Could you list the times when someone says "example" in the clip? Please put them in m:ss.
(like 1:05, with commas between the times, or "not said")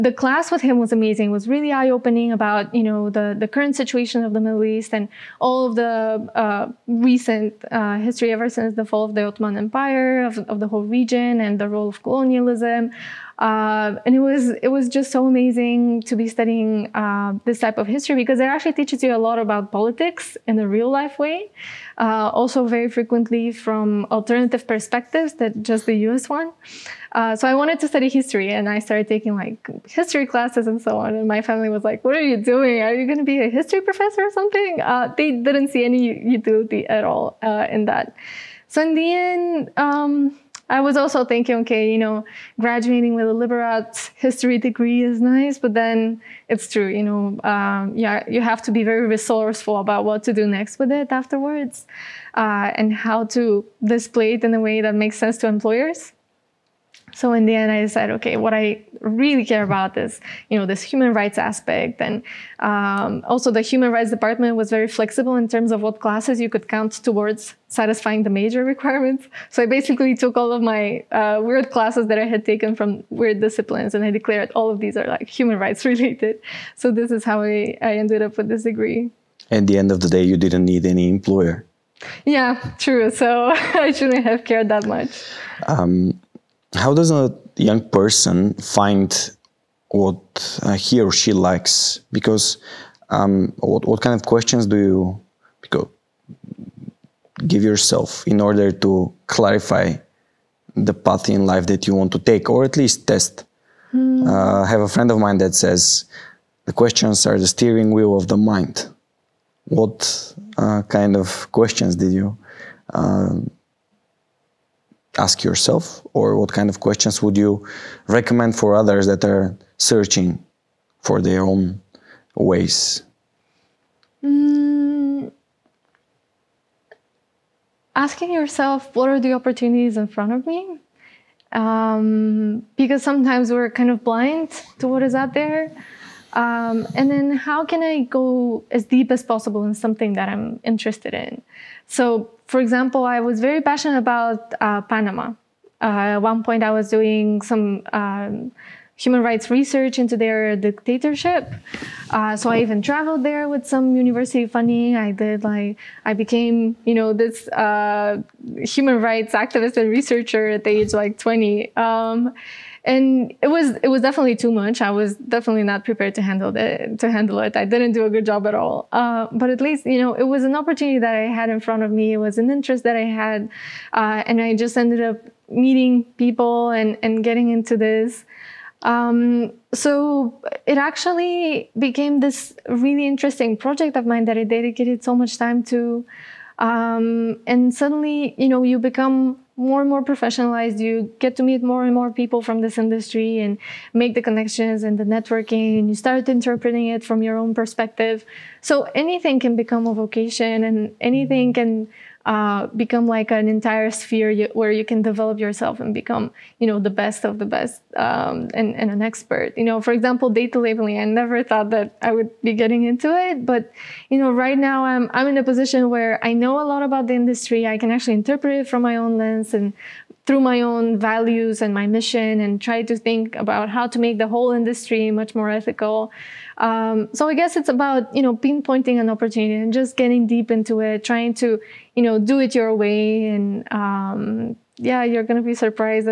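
2:22, 3:29.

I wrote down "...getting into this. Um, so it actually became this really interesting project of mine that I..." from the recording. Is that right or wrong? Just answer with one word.
right.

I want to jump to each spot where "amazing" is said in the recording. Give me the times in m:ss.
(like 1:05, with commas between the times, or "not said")
0:00, 0:15.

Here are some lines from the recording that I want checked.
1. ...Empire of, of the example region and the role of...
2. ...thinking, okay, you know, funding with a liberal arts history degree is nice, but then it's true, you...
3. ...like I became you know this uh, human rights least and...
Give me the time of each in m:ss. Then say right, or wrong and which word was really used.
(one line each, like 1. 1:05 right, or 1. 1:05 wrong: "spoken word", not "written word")
1. 0:09 wrong: "whole", not "example"
2. 0:41 wrong: "graduating", not "funding"
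3. 2:35 wrong: "activist", not "least".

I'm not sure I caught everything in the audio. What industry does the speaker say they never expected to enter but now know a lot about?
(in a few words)
Data labeling.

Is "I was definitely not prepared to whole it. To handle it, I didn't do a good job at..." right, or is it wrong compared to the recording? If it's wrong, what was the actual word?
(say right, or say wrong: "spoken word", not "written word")
wrong: "handle", not "whole".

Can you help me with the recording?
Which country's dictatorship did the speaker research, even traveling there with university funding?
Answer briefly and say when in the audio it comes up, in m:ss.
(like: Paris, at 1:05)
Panama, at 2:24.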